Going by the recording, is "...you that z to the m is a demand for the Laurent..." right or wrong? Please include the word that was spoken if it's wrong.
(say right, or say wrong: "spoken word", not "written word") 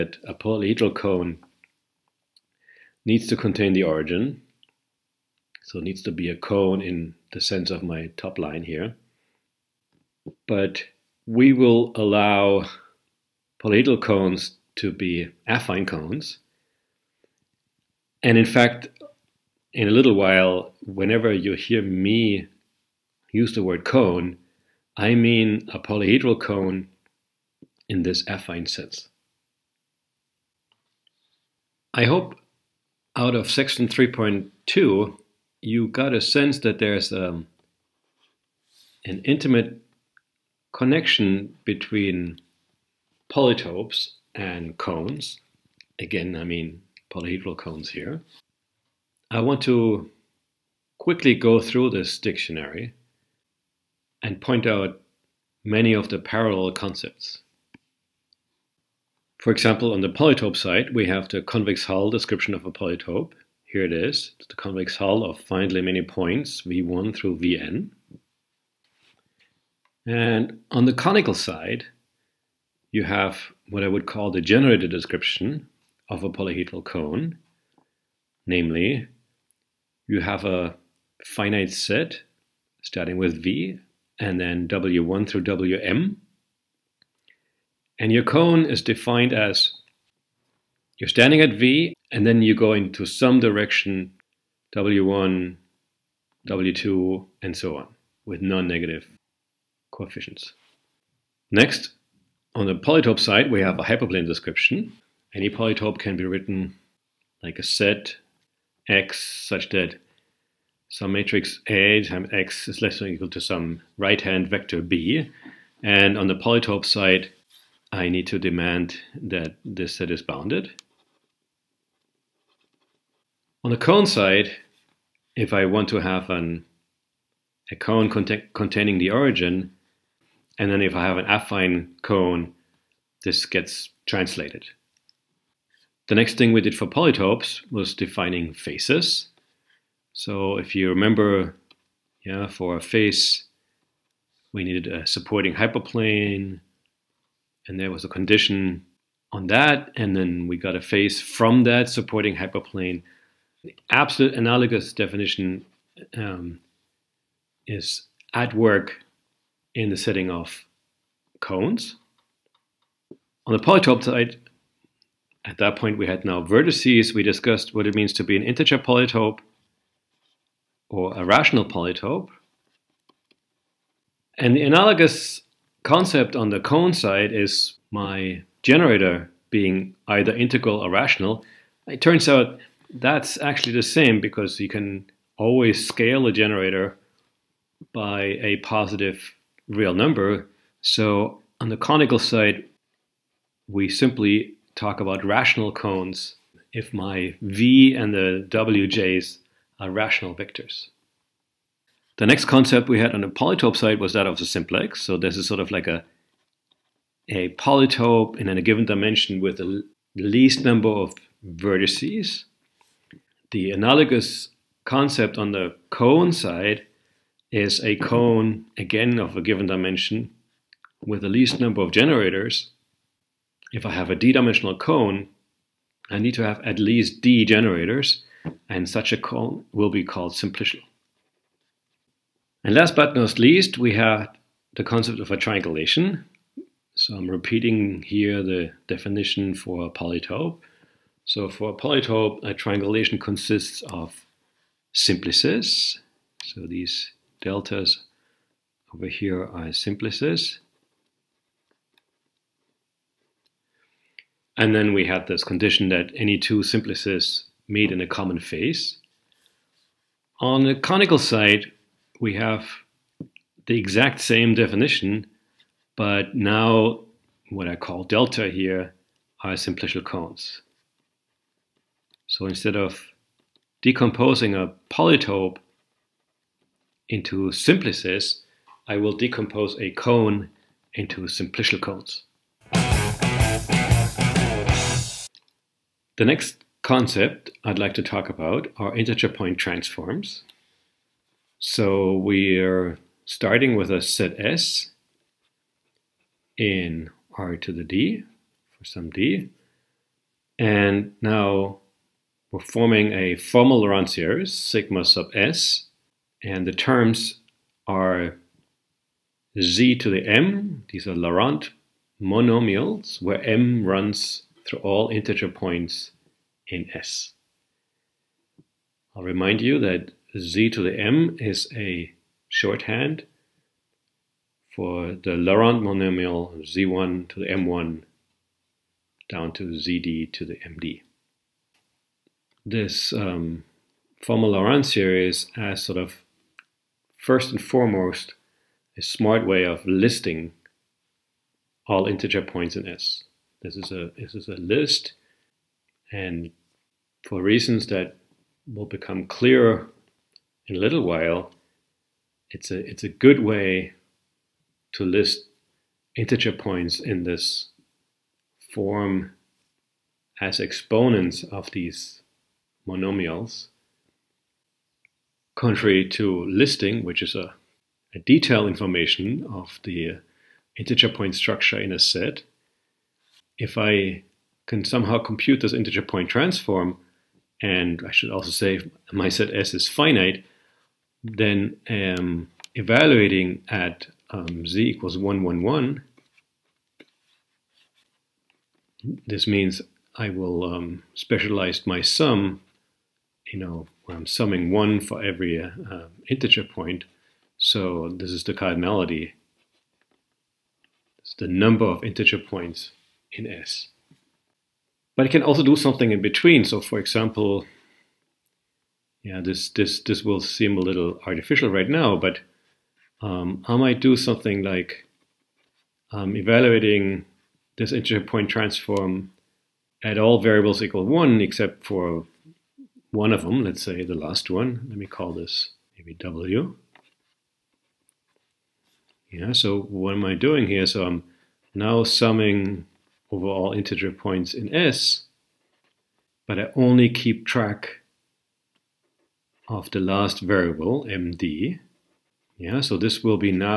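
wrong: "shorthand", not "demand".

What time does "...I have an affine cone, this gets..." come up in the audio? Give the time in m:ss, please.
2:10.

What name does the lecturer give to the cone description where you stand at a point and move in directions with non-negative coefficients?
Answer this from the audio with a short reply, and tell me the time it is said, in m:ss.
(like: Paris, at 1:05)
generated description, at 1:14.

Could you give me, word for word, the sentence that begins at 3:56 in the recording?
So I'm repeating here the definition for a polytope.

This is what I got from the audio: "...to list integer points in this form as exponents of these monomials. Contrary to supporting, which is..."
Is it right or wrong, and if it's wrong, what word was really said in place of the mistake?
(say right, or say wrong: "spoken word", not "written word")
wrong: "listing", not "supporting".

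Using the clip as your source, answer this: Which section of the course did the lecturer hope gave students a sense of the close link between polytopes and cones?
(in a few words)
3.2.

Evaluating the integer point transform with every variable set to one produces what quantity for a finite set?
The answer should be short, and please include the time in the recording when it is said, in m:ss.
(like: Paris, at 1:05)
cardinality, at 6:38.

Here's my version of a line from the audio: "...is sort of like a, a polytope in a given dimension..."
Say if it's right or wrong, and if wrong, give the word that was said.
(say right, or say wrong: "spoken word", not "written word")
right.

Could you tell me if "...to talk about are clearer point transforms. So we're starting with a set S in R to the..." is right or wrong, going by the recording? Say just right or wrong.
wrong.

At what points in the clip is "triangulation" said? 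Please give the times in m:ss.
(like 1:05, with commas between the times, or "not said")
3:55, 4:02.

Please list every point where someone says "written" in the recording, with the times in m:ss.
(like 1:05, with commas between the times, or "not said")
1:46.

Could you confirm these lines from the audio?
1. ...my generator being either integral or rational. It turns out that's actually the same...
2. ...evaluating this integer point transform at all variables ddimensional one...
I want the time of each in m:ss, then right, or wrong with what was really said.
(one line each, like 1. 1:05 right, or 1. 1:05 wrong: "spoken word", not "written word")
1. 2:57 right
2. 6:56 wrong: "equal", not "ddimensional".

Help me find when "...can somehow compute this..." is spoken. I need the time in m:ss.
6:14.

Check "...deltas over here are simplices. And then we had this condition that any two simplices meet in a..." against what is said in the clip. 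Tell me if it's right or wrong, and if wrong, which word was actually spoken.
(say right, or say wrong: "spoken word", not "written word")
right.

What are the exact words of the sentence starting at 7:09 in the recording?
Yeah, so what am I doing here?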